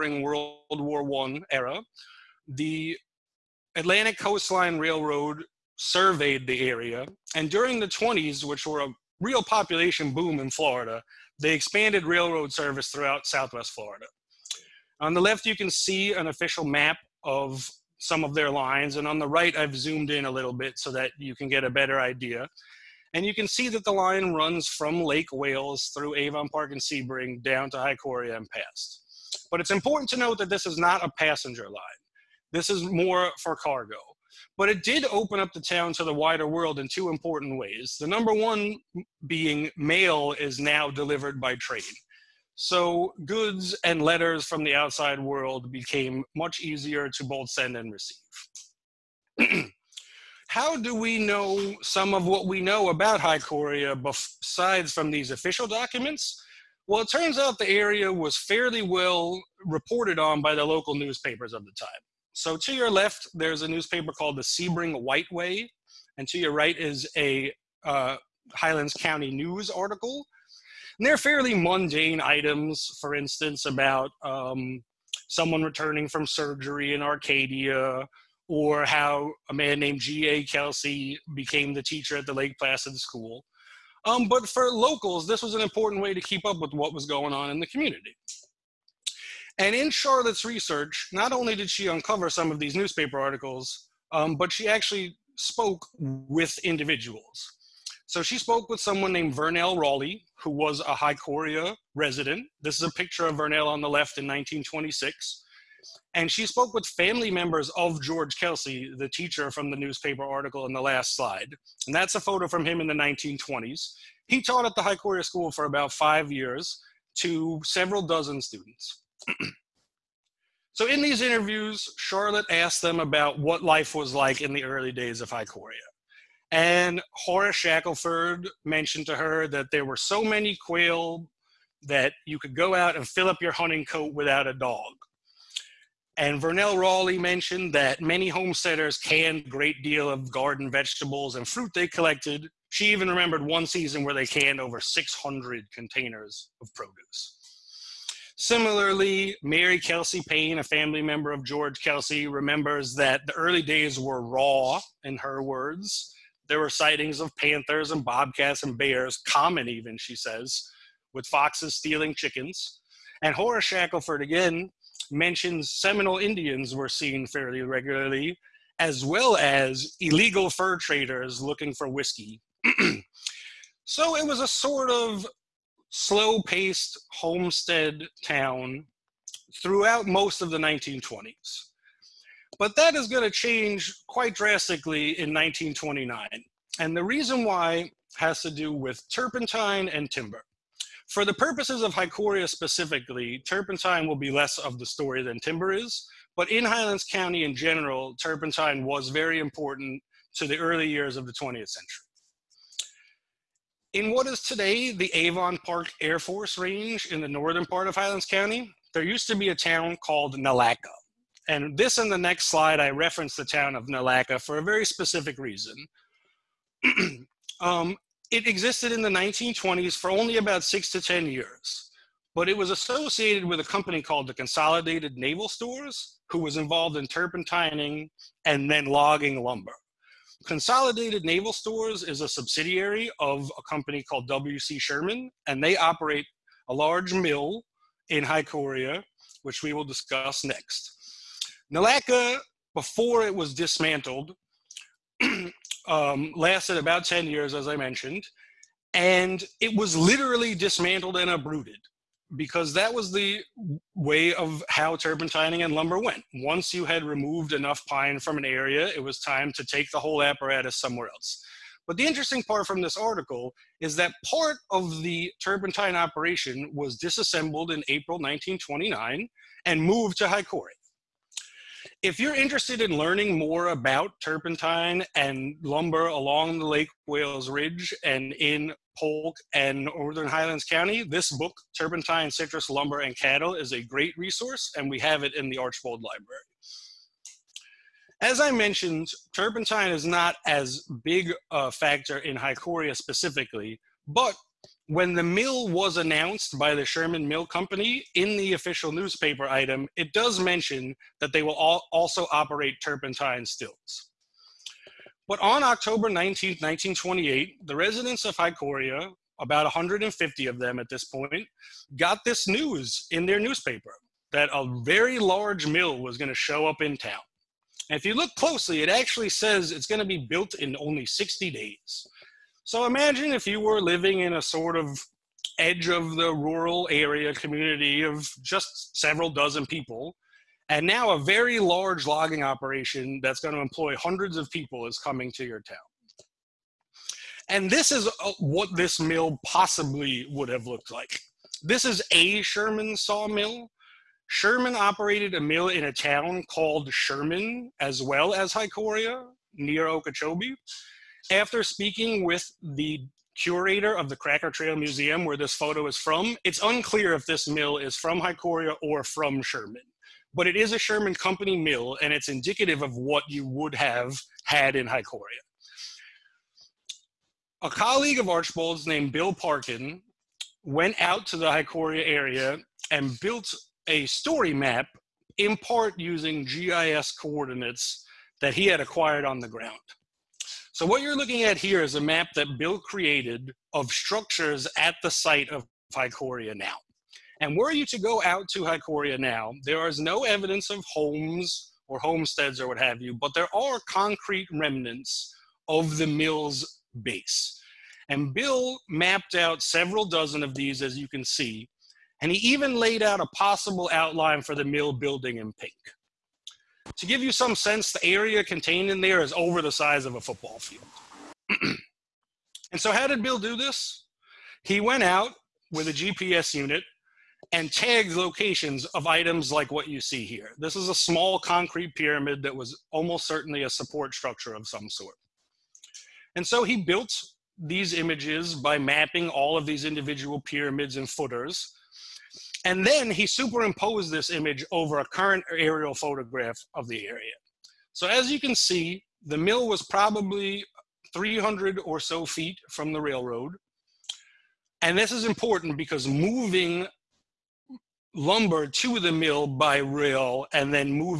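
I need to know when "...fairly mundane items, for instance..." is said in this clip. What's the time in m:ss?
1:11.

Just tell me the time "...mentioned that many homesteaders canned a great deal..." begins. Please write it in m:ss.
2:17.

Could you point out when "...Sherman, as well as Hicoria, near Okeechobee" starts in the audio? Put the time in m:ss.
5:46.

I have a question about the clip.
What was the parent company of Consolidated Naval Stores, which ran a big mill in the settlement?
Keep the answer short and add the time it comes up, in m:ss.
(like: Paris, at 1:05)
WC Sherman, at 3:54.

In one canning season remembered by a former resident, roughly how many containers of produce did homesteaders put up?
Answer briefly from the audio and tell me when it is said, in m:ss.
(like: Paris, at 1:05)
600, at 2:24.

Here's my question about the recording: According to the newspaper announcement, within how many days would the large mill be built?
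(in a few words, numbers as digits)
60 days.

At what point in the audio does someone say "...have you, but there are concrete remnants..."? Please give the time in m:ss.
6:32.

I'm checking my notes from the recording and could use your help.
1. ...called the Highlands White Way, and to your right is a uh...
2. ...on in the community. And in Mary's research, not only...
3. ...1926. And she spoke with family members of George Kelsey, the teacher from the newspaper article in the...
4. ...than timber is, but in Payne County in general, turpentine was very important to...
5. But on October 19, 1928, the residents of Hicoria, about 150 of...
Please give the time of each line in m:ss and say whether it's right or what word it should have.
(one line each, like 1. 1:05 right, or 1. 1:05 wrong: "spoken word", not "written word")
1. 1:04 wrong: "Sebring", not "Highlands"
2. 1:27 wrong: "Charlotte", not "Mary"
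3. 1:44 right
4. 3:15 wrong: "Highlands", not "Payne"
5. 5:05 right.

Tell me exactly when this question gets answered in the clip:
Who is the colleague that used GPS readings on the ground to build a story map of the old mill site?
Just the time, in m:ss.
6:09.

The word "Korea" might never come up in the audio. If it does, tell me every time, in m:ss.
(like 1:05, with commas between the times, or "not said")
0:53, 3:58.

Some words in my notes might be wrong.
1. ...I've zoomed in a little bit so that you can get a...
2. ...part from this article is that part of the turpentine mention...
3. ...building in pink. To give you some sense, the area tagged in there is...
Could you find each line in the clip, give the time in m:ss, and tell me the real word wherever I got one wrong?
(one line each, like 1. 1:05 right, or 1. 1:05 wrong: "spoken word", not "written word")
1. 0:19 right
2. 4:22 wrong: "operation", not "mention"
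3. 6:44 wrong: "contained", not "tagged".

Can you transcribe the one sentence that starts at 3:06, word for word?
And the reason why has to do with turpentine and timber.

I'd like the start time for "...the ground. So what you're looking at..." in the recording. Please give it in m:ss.
6:19.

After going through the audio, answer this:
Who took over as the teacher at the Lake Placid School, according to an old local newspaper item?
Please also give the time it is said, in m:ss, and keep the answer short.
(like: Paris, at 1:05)
G.A. Kelsey, at 1:20.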